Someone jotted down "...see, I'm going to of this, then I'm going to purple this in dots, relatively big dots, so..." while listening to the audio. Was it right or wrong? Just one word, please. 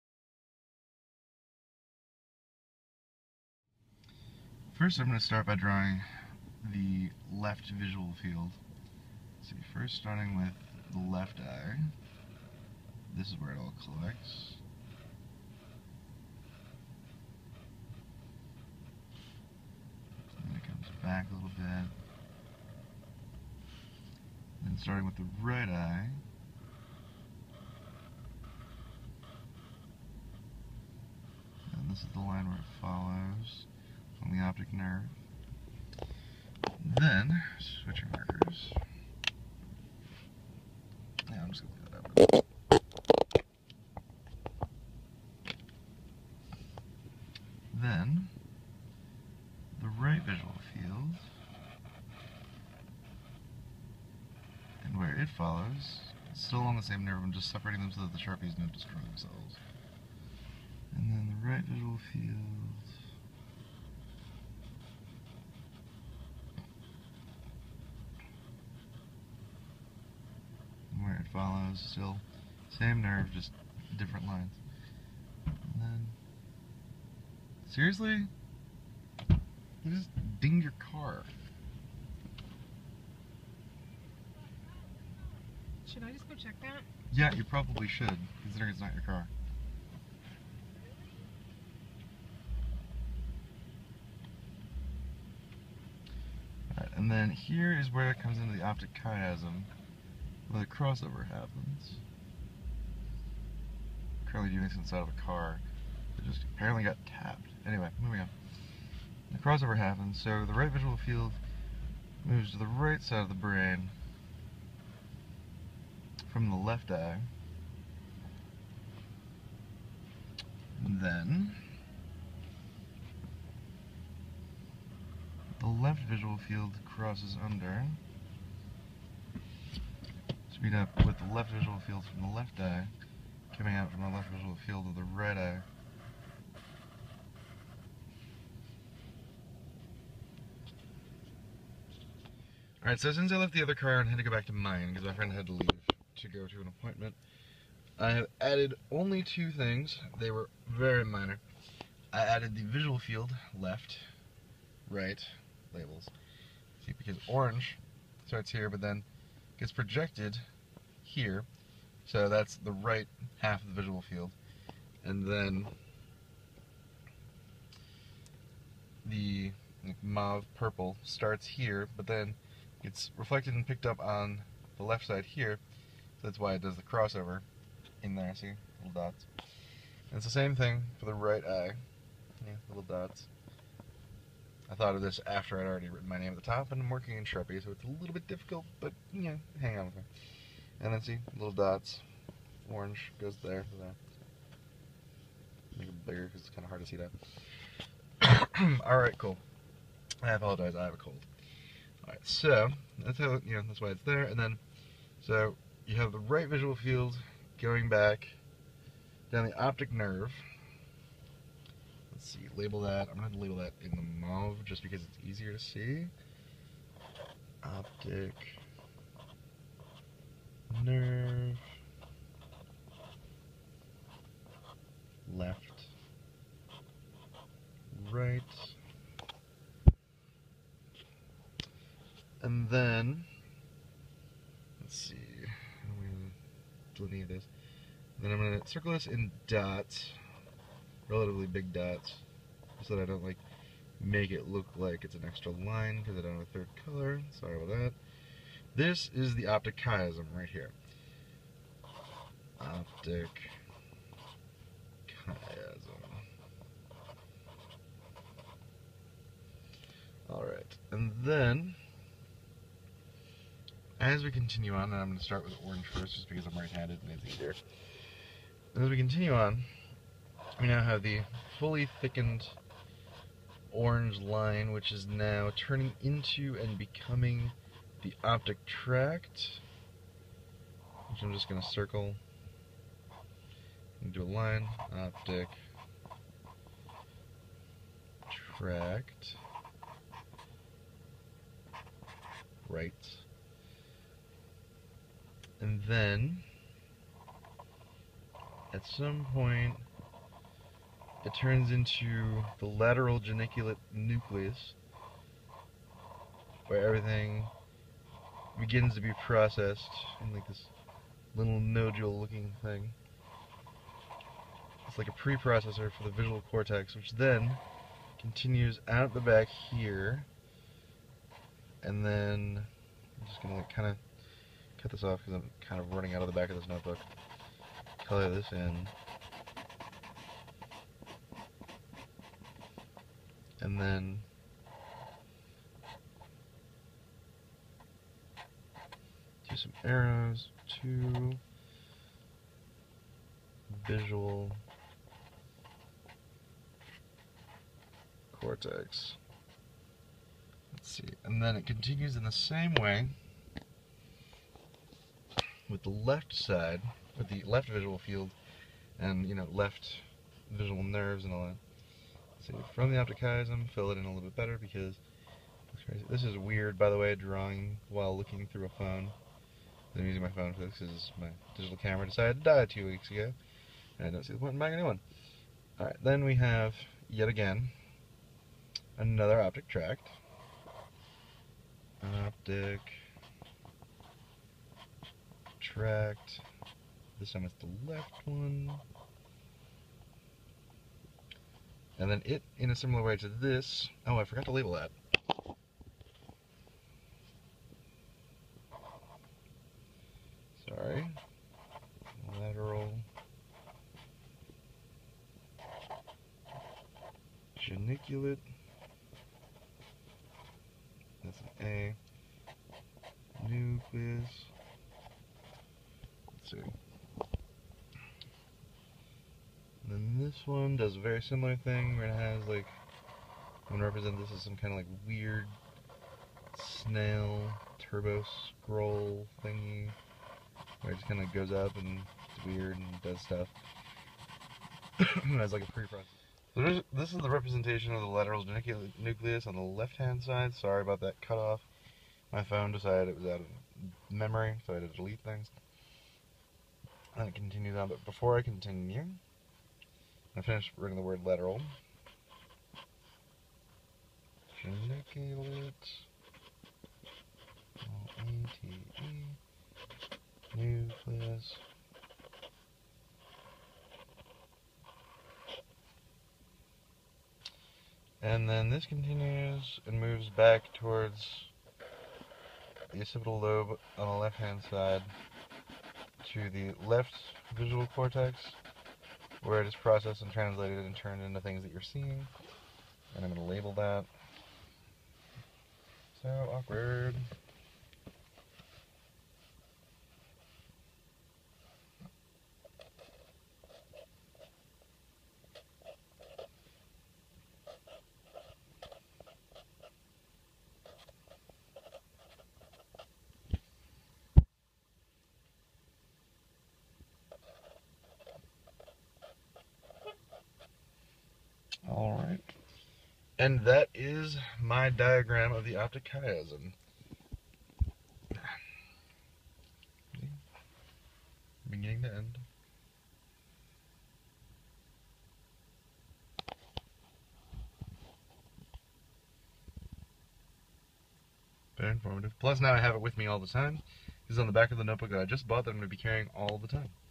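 wrong.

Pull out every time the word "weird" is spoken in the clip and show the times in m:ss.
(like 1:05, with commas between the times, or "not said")
6:06, 7:05, 7:12.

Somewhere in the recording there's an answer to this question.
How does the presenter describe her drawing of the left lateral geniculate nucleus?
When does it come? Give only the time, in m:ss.
7:06.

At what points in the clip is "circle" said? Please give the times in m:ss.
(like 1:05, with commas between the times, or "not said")
3:58, 4:41.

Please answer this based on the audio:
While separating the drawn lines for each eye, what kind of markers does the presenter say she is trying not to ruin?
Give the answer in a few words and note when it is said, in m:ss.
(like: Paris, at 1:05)
Sharpies, at 0:58.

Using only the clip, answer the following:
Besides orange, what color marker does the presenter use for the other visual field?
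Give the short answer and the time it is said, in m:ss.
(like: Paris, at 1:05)
Mauve purple, at 2:50.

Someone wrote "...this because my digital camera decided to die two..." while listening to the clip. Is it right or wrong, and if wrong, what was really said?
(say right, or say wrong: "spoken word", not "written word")
right.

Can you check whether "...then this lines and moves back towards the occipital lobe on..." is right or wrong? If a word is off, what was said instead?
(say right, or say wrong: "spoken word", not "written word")
wrong: "continues", not "lines".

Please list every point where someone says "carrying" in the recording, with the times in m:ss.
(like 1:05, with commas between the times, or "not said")
8:55.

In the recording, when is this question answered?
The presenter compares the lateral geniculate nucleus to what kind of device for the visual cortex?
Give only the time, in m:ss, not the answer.
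5:15.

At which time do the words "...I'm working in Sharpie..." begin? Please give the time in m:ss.
3:06.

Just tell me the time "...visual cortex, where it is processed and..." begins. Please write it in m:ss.
7:57.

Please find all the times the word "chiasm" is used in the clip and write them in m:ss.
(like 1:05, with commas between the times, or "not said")
1:39, 4:09, 4:15, 6:03, 8:36.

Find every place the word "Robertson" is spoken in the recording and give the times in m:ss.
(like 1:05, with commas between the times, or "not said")
not said.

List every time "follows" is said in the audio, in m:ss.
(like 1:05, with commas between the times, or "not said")
0:32, 0:55, 1:11.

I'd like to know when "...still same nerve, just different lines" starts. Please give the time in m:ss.
1:11.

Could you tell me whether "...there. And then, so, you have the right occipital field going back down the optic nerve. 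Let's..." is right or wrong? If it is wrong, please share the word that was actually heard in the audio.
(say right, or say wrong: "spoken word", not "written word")
wrong: "visual", not "occipital".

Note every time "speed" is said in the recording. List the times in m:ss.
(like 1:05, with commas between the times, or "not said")
2:10.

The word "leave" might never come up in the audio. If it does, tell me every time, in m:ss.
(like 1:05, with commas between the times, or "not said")
0:42, 2:25.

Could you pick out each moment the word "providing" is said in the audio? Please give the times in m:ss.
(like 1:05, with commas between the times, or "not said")
not said.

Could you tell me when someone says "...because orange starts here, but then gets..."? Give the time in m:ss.
2:36.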